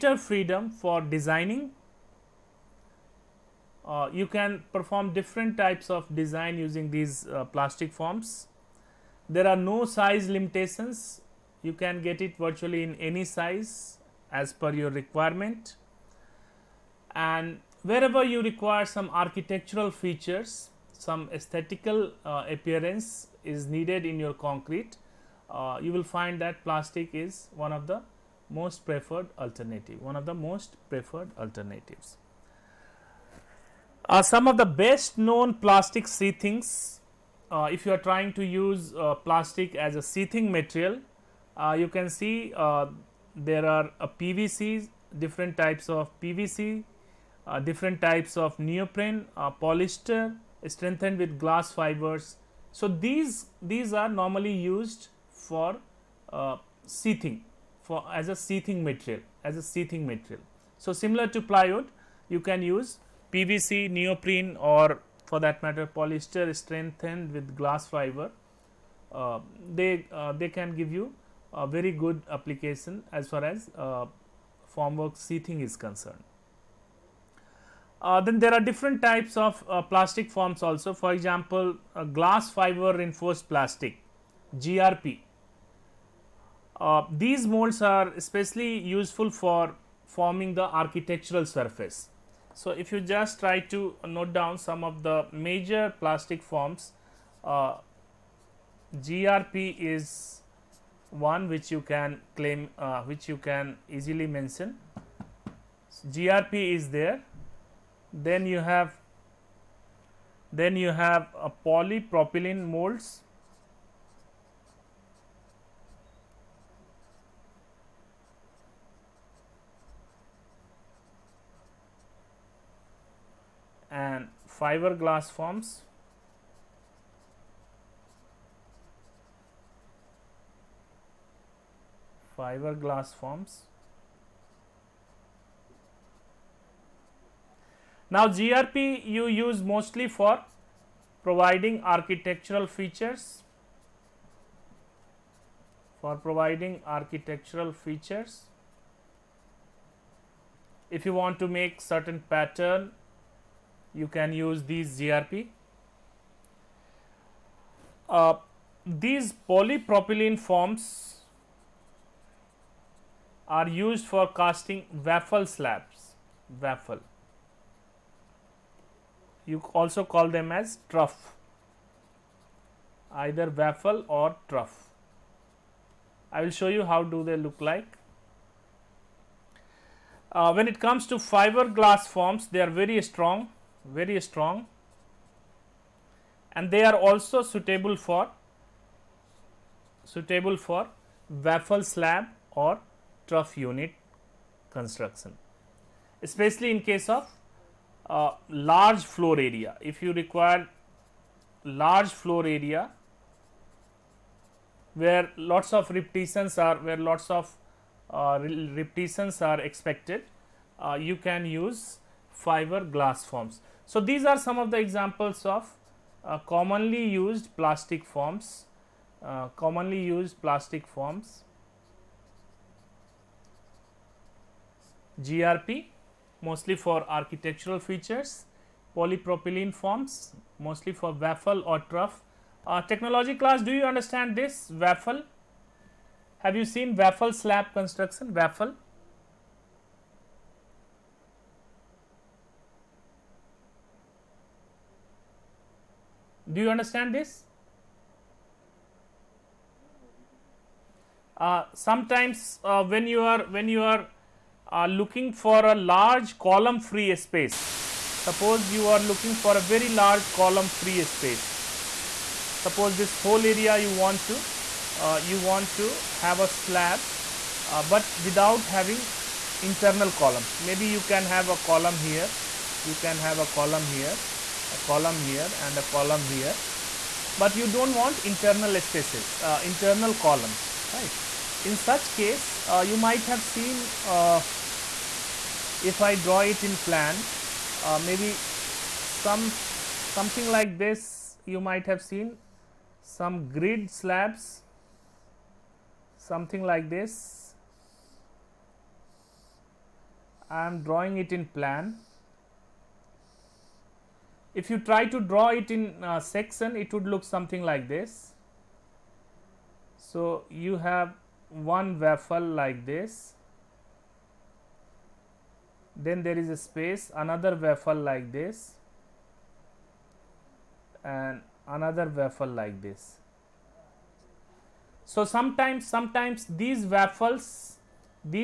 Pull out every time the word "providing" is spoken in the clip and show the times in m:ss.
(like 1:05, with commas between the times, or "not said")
2:21, 2:26.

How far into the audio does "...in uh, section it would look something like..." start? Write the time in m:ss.
5:05.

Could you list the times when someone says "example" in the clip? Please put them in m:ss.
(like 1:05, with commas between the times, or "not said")
1:21, 3:34.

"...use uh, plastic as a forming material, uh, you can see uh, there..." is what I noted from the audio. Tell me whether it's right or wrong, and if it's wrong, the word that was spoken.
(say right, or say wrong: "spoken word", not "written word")
wrong: "sheathing", not "forming".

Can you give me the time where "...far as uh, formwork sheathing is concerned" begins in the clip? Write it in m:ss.
1:13.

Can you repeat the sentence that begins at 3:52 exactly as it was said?
Uh, technology class do you understand this waffle?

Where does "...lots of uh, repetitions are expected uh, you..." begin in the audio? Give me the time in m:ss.
3:26.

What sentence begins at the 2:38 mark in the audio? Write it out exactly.
Uh, these polypropylene forms are used for casting waffle slabs, waffle.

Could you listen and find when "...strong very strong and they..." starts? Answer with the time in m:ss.
3:03.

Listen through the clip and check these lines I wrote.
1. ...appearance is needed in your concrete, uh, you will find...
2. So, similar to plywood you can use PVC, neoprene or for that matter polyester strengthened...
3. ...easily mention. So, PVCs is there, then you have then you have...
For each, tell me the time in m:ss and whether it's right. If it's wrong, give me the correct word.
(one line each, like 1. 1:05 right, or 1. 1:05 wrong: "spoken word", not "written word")
1. 0:22 right
2. 1:00 right
3. 1:43 wrong: "GRP", not "PVCs".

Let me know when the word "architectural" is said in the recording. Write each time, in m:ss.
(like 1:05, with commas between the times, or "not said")
0:19, 1:30, 2:21, 2:26, 3:47.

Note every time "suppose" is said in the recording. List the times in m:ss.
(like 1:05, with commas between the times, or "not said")
4:18, 4:22.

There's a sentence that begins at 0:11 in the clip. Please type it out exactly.
You can get it virtually in any size as per your requirement.